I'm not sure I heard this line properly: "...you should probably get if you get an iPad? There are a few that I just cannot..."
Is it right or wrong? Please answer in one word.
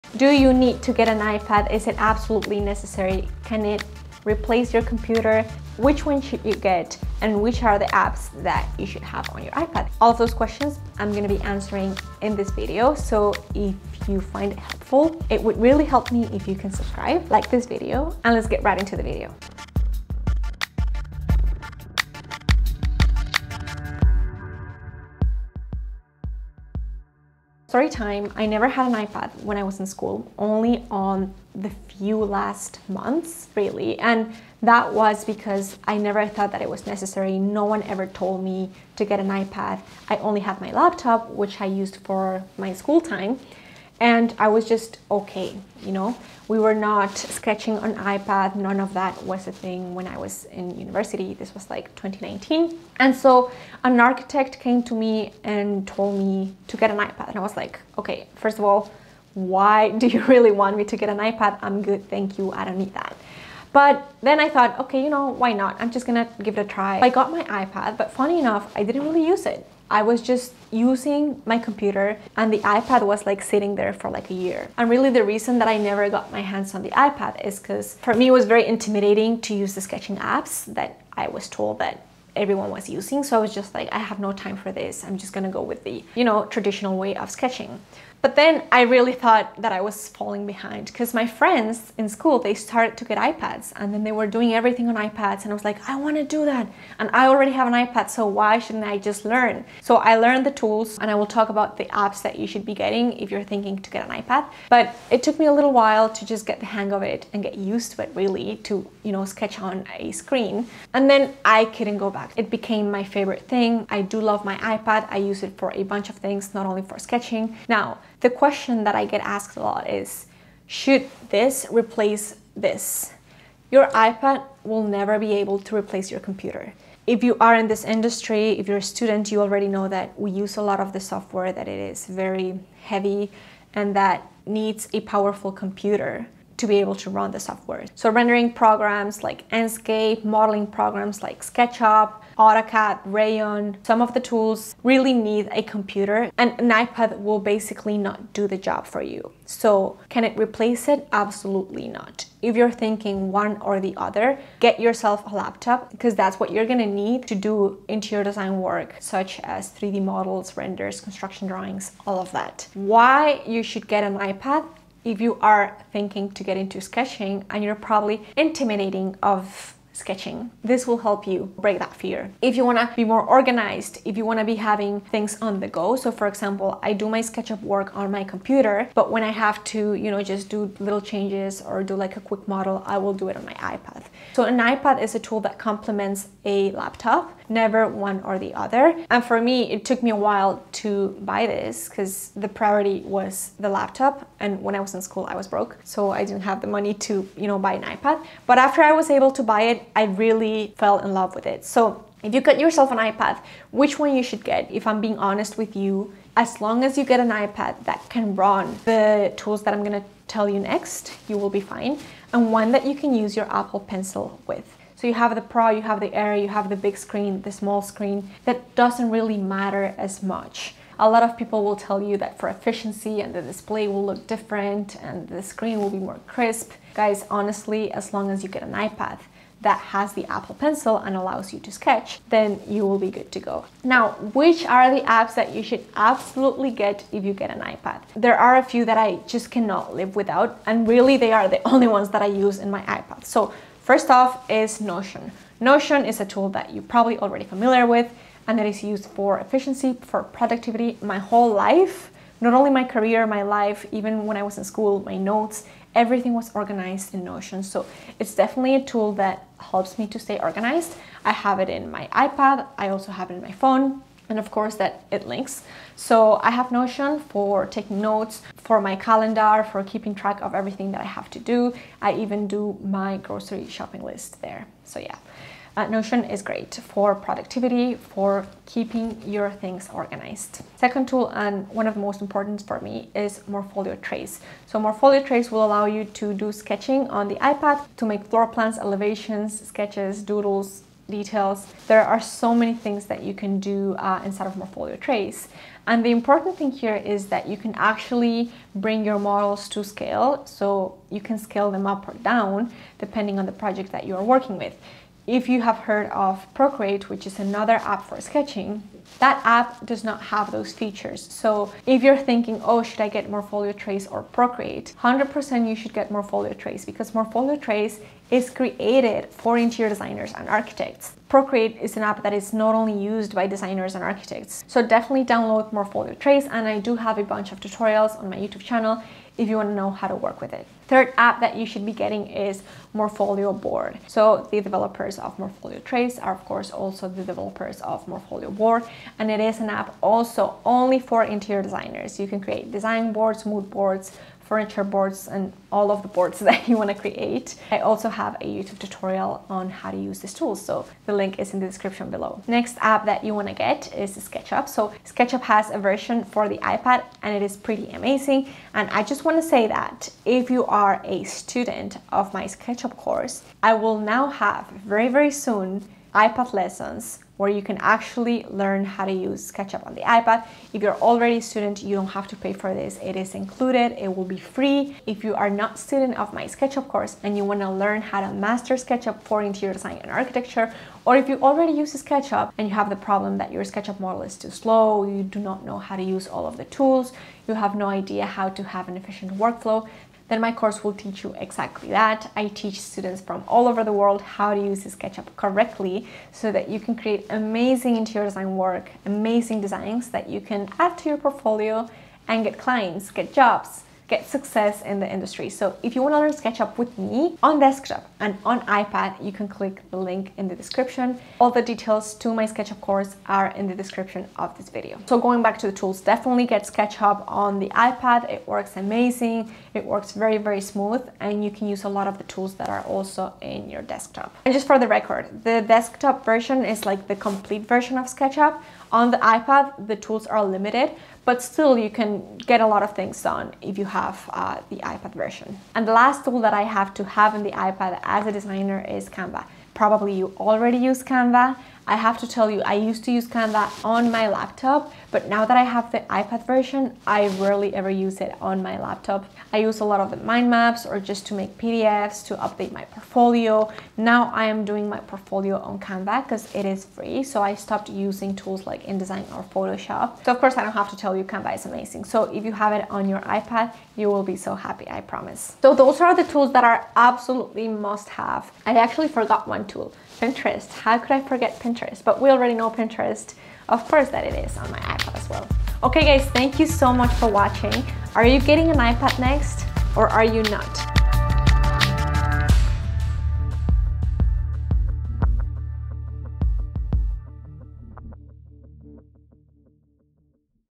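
wrong.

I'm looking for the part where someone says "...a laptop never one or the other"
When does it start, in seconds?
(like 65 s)
186 s.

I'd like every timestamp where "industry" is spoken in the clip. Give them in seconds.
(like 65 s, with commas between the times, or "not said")
127 s, 405 s.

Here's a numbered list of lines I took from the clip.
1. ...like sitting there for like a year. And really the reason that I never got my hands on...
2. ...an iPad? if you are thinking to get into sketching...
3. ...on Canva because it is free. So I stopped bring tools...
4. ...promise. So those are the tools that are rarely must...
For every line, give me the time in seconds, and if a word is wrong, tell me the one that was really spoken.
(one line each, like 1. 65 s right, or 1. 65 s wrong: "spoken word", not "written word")
1. 73 s right
2. 164 s right
3. 455 s wrong: "using", not "bring"
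4. 465 s wrong: "absolutely", not "rarely".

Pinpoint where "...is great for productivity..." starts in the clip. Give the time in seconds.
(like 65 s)
276 s.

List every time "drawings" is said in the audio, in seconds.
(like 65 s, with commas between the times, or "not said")
161 s.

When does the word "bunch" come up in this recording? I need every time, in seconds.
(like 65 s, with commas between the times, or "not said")
115 s, 327 s.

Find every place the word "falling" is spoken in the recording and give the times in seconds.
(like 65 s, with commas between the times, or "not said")
90 s.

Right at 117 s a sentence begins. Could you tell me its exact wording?
Now, the question that I get asked a lot is, should this replace this?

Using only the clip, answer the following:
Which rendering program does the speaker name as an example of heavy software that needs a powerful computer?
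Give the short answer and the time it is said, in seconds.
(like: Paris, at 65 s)
Enscape, at 139 s.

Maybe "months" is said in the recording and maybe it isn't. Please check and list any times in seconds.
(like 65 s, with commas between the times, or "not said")
32 s.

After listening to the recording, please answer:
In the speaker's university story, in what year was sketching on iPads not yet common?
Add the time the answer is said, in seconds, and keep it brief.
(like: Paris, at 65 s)
2019, at 51 s.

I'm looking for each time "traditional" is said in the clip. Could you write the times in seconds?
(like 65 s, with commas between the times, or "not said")
86 s.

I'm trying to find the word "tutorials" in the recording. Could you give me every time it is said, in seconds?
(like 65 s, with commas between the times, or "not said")
327 s, 348 s.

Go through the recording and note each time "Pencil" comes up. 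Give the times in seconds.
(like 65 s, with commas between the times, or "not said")
213 s, 230 s.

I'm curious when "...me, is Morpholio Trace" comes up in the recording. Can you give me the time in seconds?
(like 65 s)
282 s.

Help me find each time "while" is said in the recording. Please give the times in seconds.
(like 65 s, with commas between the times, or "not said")
105 s, 190 s.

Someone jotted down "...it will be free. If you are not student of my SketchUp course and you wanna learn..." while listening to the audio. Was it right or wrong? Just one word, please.
right.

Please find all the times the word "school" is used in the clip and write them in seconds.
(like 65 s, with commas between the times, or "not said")
29 s, 42 s, 92 s, 195 s, 254 s.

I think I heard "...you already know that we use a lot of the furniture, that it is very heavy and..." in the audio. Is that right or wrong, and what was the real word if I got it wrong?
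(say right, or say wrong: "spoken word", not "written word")
wrong: "software", not "furniture".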